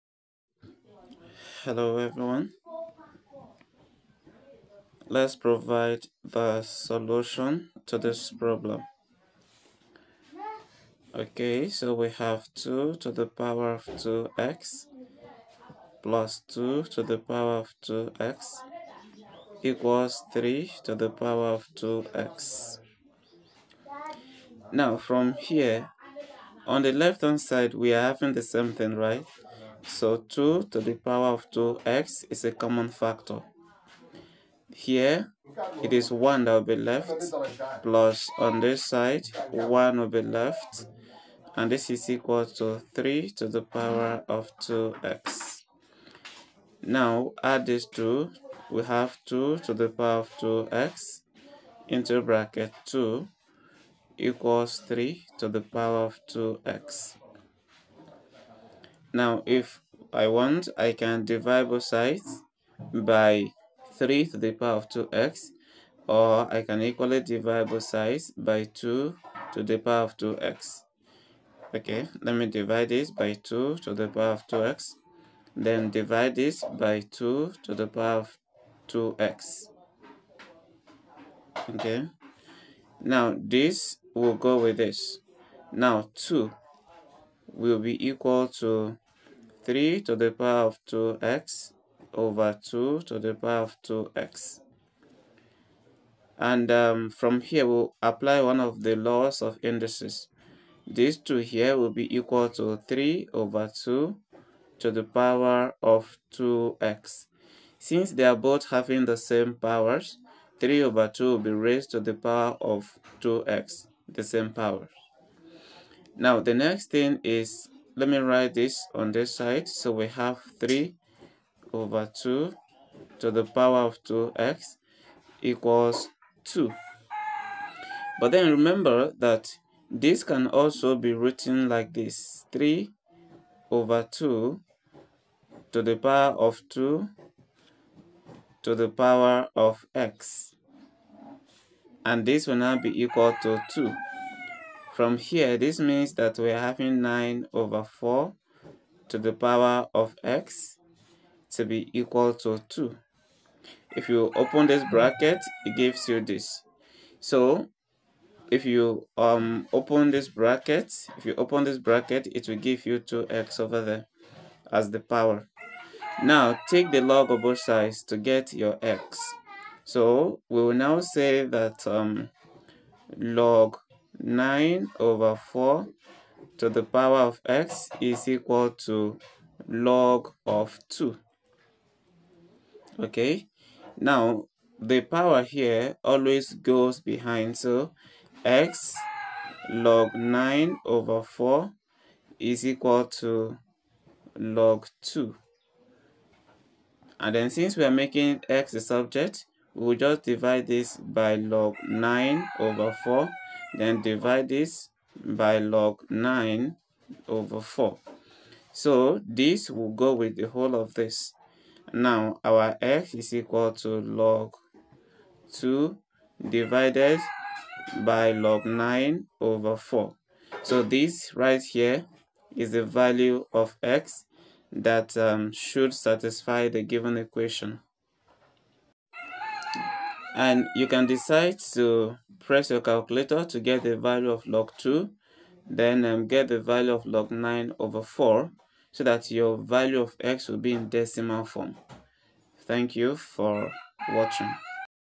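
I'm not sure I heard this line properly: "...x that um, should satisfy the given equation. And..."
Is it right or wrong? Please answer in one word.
right.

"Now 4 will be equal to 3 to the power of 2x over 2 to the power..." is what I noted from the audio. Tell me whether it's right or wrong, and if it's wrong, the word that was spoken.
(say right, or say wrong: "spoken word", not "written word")
wrong: "2", not "4".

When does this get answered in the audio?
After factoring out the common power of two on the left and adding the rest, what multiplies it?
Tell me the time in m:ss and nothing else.
0:52.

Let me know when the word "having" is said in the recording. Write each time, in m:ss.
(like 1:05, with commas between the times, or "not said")
0:28, 1:48, 2:26.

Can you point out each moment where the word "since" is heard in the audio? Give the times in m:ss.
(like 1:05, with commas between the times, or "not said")
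1:47, 3:17.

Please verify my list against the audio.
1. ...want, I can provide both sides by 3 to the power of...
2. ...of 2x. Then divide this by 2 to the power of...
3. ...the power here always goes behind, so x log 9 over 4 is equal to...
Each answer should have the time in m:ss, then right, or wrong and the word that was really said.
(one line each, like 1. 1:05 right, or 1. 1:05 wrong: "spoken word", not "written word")
1. 1:00 wrong: "divide", not "provide"
2. 1:14 right
3. 3:04 right.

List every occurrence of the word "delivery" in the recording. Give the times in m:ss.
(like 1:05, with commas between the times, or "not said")
not said.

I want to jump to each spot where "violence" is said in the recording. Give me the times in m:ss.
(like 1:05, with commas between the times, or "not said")
not said.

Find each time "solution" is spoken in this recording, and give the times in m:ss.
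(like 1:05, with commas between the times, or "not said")
0:06.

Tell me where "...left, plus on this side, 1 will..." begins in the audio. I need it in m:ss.
0:36.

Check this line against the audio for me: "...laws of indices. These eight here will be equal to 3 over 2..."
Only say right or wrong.
wrong.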